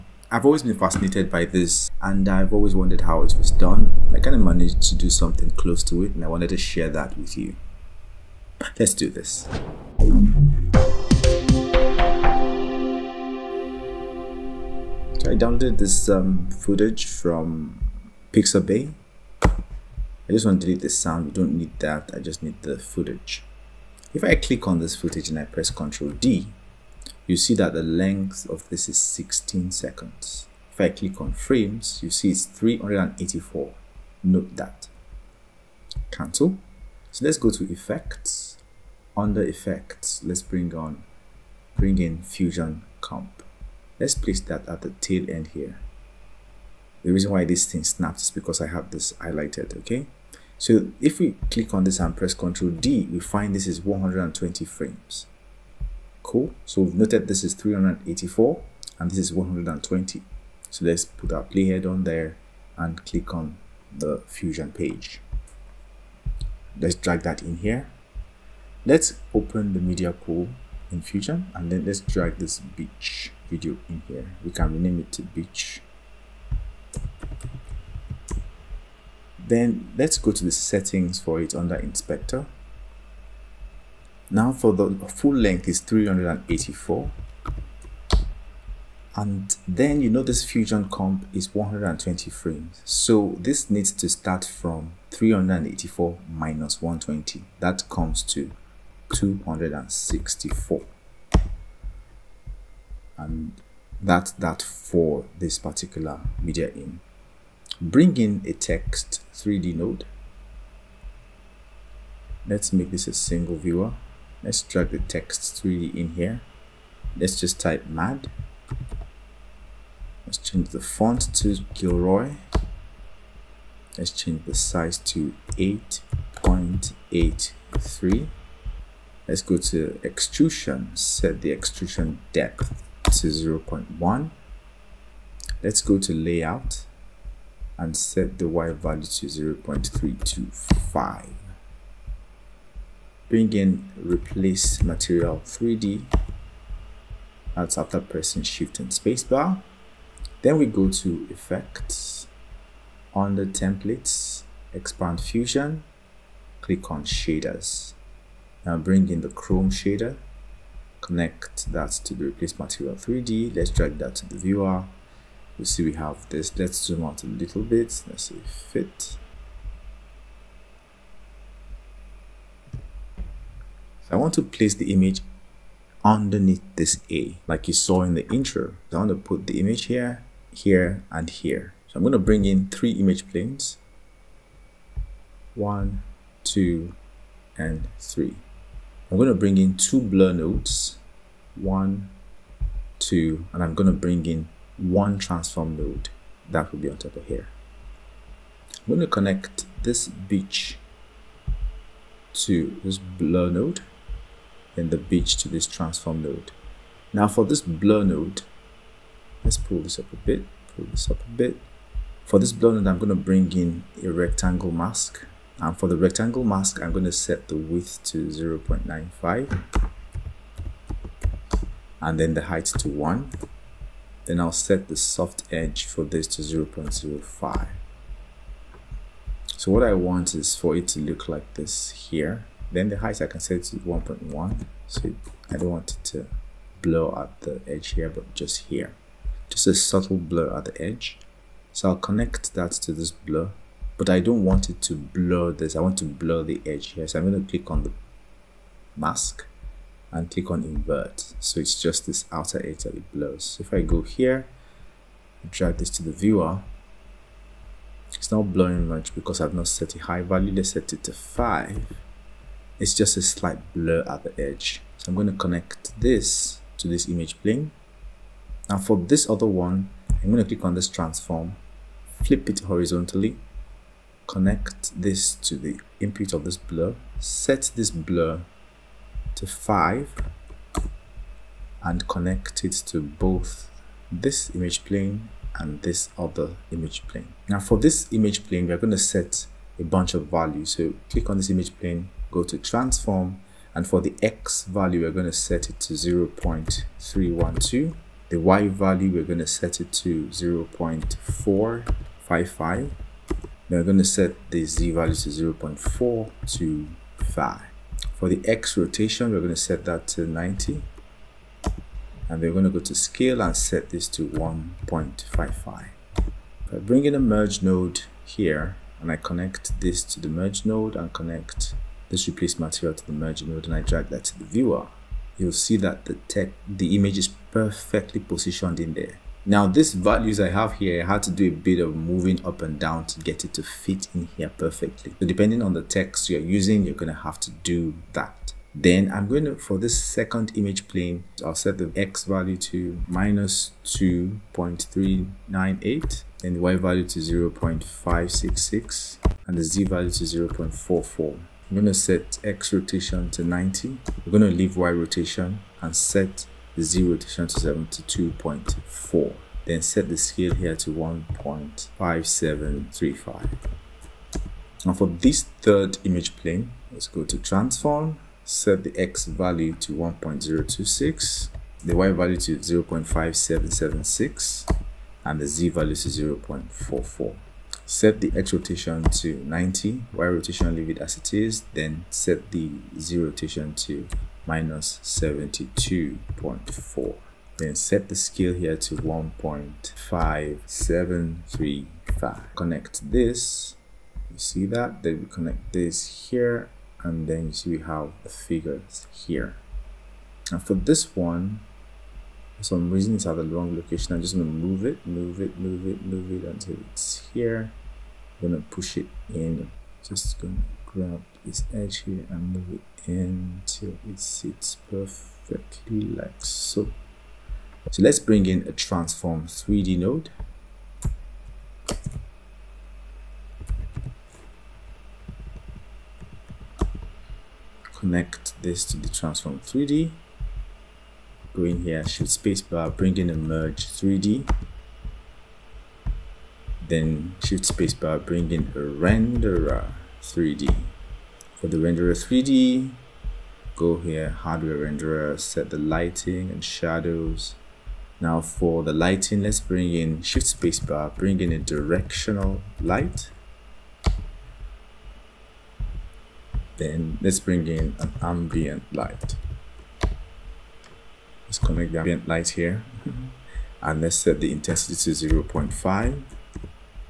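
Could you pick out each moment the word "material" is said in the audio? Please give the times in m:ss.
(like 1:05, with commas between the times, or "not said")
2:24, 2:42, 5:22.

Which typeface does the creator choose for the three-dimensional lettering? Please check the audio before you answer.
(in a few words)
Gilroy.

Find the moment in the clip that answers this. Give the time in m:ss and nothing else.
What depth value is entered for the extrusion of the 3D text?
2:13.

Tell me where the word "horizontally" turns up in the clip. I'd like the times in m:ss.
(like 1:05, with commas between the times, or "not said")
4:32.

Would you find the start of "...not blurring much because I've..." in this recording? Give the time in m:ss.
4:18.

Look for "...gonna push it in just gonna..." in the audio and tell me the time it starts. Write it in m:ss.
6:48.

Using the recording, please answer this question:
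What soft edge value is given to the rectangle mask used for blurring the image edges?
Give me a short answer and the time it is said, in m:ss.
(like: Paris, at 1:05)
0.05, at 3:46.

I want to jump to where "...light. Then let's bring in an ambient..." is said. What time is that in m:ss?
7:32.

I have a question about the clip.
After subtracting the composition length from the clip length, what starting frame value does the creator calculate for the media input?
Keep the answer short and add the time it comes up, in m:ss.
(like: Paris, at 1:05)
264, at 1:39.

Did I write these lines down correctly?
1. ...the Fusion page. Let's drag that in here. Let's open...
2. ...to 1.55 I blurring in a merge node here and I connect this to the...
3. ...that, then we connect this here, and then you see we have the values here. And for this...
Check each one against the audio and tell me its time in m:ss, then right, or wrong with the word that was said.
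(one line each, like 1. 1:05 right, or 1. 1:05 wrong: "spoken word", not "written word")
1. 1:03 right
2. 5:14 wrong: "bring", not "blurring"
3. 6:34 wrong: "figures", not "values".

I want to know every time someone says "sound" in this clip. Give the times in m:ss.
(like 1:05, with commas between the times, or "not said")
0:20.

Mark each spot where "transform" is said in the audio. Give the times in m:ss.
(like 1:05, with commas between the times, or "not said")
3:15, 3:25, 4:30, 4:52, 6:07, 6:58, 7:09.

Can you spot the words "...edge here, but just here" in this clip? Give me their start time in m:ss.
3:57.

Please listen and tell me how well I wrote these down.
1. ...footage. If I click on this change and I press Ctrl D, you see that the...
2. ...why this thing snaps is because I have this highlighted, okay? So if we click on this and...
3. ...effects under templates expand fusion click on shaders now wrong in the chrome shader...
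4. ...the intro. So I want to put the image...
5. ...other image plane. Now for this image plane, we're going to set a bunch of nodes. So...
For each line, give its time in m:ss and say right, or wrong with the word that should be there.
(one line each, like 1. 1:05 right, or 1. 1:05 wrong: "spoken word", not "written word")
1. 0:22 wrong: "footage", not "change"
2. 0:47 right
3. 2:31 wrong: "bring", not "wrong"
4. 2:58 right
5. 4:46 wrong: "values", not "nodes".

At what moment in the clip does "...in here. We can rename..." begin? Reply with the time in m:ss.
1:13.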